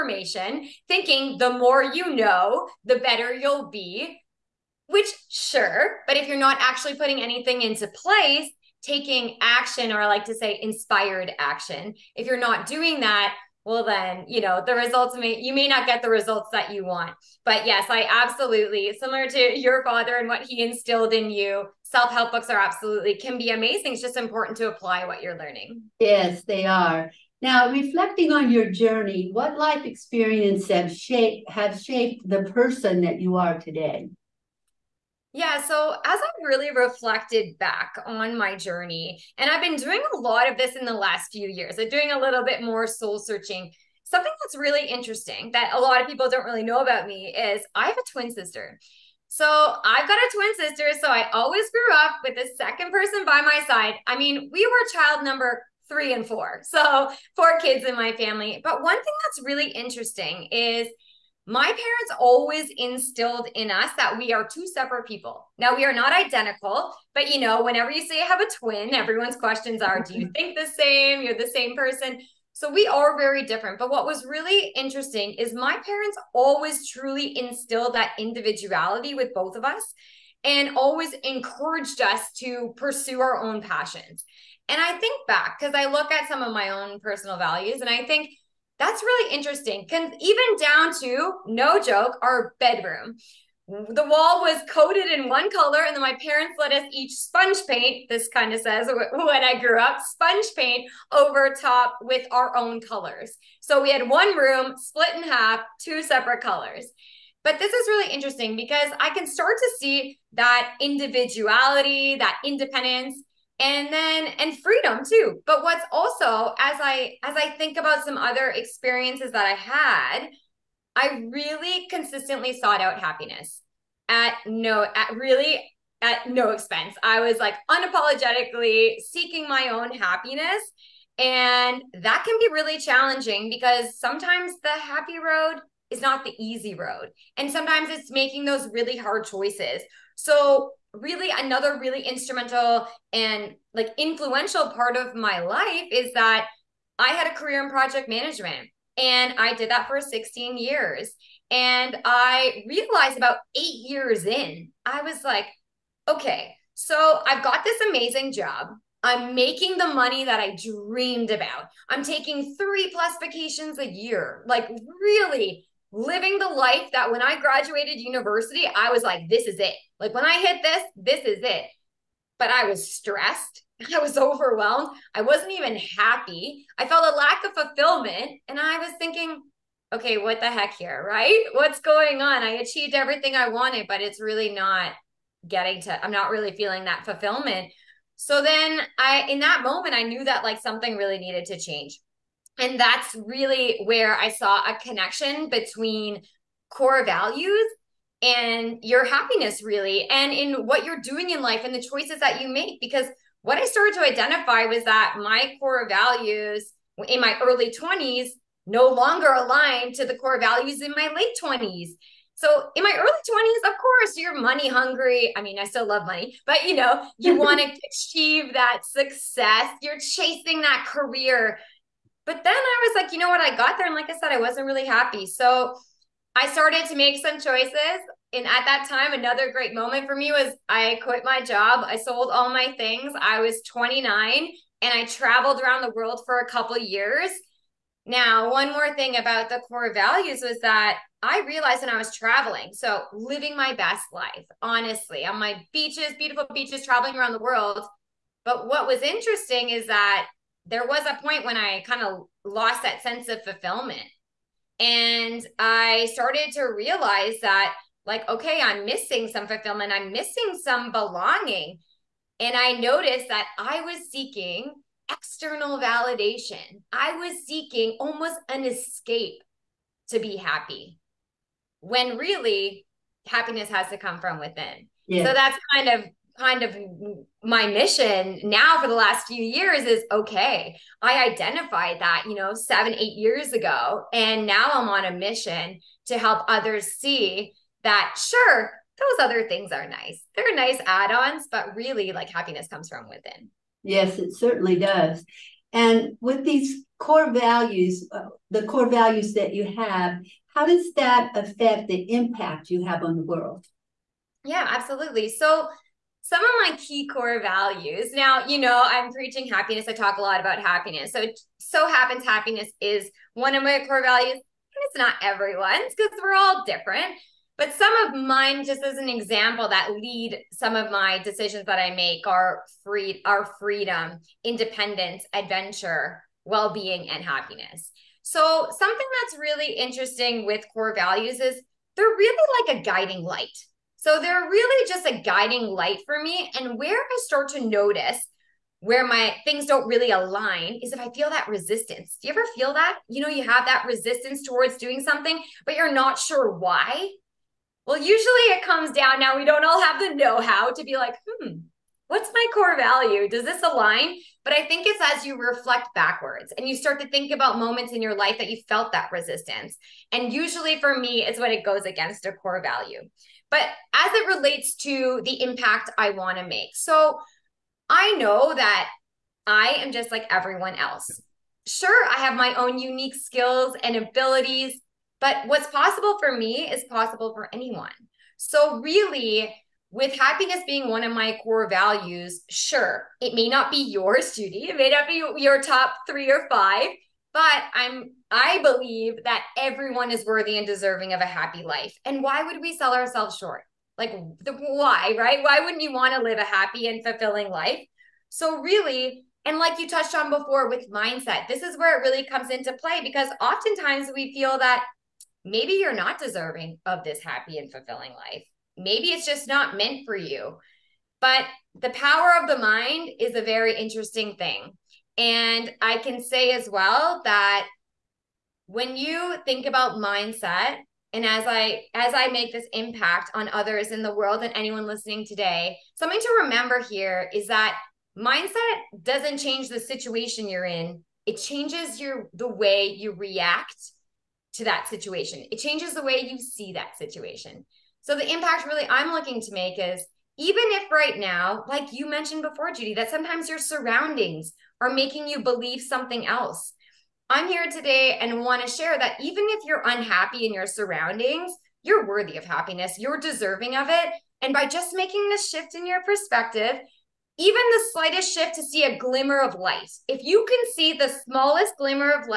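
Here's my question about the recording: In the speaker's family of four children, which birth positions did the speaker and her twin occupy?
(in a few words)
3 and 4.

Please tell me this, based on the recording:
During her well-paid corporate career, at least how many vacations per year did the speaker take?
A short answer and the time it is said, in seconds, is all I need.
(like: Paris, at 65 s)
3, at 162 s.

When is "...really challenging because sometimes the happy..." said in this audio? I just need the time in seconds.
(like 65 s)
132 s.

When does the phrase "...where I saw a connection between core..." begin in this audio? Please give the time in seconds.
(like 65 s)
193 s.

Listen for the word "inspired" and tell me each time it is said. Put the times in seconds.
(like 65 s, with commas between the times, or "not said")
10 s.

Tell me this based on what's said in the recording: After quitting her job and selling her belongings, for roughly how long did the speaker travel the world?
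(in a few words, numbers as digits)
A couple years.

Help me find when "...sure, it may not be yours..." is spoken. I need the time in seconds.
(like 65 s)
382 s.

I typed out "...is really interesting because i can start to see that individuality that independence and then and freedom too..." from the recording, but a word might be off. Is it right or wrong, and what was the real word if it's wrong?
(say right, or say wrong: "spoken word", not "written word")
right.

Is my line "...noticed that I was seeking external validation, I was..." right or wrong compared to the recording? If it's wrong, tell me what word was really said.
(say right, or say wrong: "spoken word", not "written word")
right.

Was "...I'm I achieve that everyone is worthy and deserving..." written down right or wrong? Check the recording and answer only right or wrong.
wrong.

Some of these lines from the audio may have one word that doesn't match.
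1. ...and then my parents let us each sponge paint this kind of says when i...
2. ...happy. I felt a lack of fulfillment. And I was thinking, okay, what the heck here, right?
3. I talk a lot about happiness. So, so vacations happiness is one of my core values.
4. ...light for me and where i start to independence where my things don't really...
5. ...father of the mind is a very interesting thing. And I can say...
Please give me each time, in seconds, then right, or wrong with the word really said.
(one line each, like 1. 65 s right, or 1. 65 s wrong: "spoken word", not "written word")
1. 95 s right
2. 175 s right
3. 309 s wrong: "happens", not "vacations"
4. 335 s wrong: "notice", not "independence"
5. 411 s wrong: "power", not "father".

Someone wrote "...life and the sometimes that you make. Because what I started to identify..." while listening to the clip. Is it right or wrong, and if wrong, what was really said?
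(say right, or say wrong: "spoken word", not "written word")
wrong: "choices", not "sometimes".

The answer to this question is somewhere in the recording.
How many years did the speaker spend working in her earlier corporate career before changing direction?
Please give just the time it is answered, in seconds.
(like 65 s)
149 s.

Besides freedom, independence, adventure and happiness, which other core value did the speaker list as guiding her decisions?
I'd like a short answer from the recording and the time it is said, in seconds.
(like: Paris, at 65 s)
Well-being, at 326 s.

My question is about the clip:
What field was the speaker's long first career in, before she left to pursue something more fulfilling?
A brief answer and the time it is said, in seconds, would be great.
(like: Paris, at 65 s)
Project management, at 147 s.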